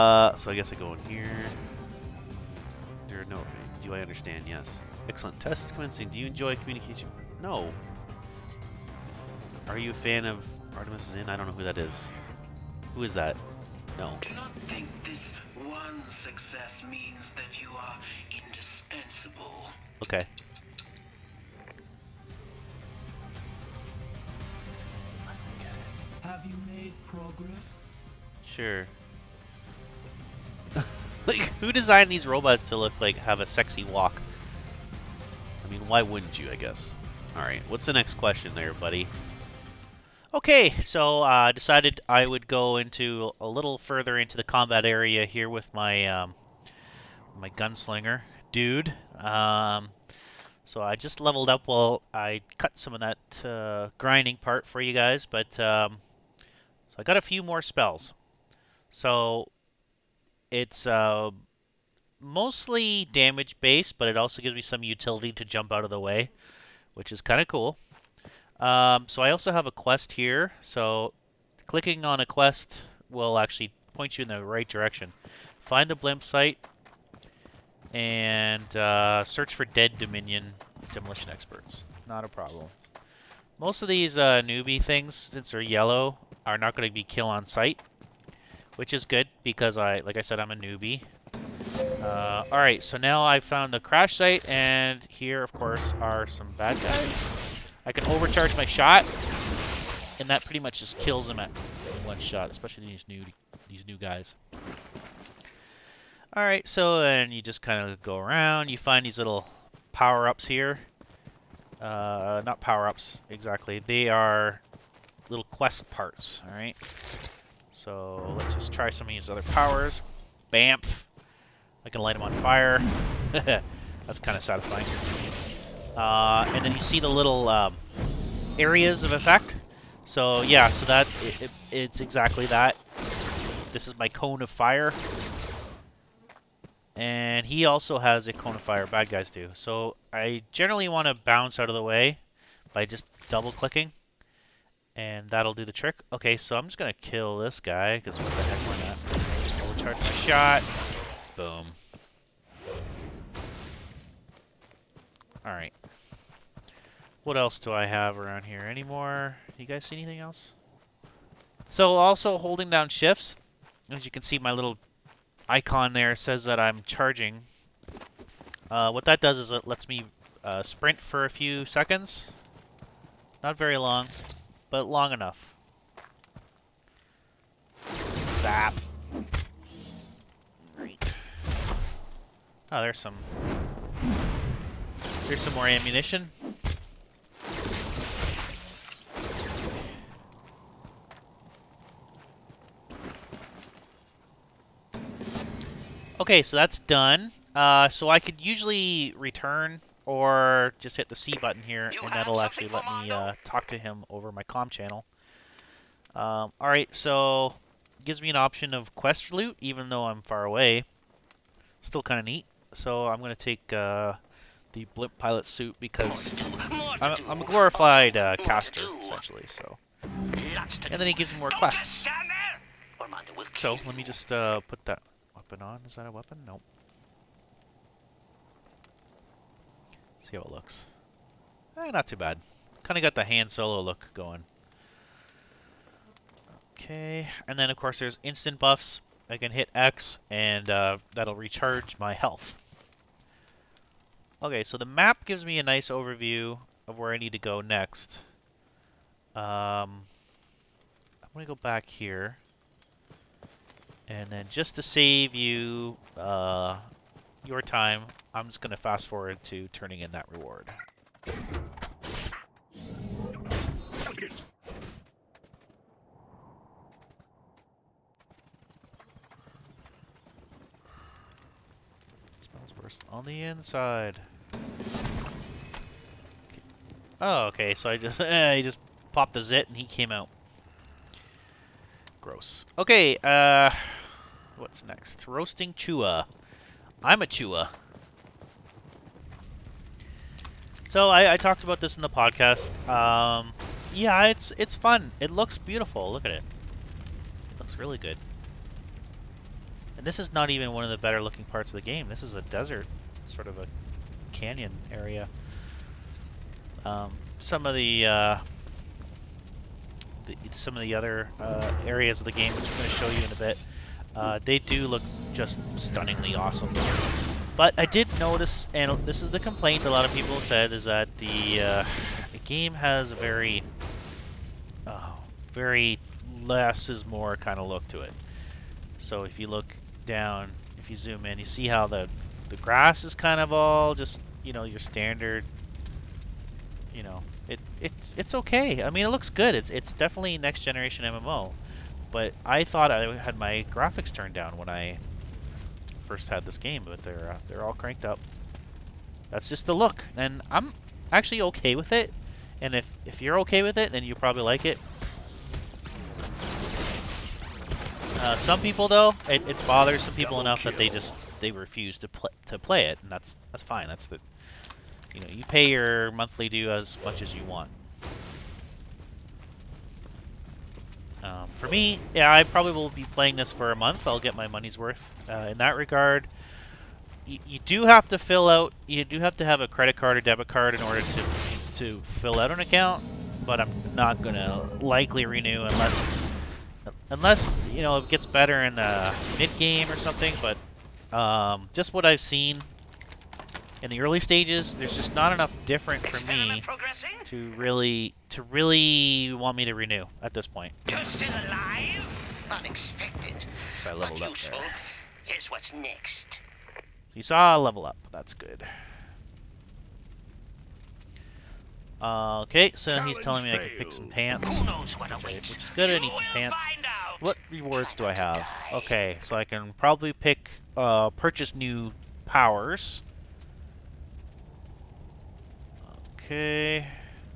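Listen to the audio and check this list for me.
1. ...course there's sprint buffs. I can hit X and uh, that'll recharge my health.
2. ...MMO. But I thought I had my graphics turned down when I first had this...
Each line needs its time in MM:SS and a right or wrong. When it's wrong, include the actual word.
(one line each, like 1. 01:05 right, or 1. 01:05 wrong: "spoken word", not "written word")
1. 03:57 wrong: "instant", not "sprint"
2. 05:41 right.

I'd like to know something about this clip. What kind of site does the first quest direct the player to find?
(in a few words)
blimp site.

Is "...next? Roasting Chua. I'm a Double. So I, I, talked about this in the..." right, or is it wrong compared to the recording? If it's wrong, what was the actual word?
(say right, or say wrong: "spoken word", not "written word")
wrong: "Chua", not "Double".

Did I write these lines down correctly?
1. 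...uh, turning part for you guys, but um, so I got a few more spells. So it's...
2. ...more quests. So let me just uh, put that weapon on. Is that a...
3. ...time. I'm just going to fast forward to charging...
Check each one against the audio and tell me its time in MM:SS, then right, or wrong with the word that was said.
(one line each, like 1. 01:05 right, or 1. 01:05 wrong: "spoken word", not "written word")
1. 00:53 wrong: "grinding", not "turning"
2. 03:41 right
3. 04:17 wrong: "turning", not "charging".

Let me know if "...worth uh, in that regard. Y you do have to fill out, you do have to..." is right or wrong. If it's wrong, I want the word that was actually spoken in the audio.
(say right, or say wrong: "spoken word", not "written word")
right.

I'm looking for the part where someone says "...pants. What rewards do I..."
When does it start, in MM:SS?
06:56.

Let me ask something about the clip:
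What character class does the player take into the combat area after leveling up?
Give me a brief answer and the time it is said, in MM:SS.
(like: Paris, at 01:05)
gunslinger, at 00:47.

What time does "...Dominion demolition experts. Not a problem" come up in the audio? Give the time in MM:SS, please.
01:19.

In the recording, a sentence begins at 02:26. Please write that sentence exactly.
Okay, so I'm just gonna kill this guy, because what the heck, why not?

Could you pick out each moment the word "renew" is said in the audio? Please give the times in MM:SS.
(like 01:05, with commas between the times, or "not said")
06:25, 06:39.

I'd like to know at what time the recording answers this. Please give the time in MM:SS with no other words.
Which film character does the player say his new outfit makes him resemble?
03:53.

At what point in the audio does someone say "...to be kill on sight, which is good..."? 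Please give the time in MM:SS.
01:26.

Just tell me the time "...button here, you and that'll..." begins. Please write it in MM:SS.
03:21.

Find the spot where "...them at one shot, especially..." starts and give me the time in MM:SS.
01:41.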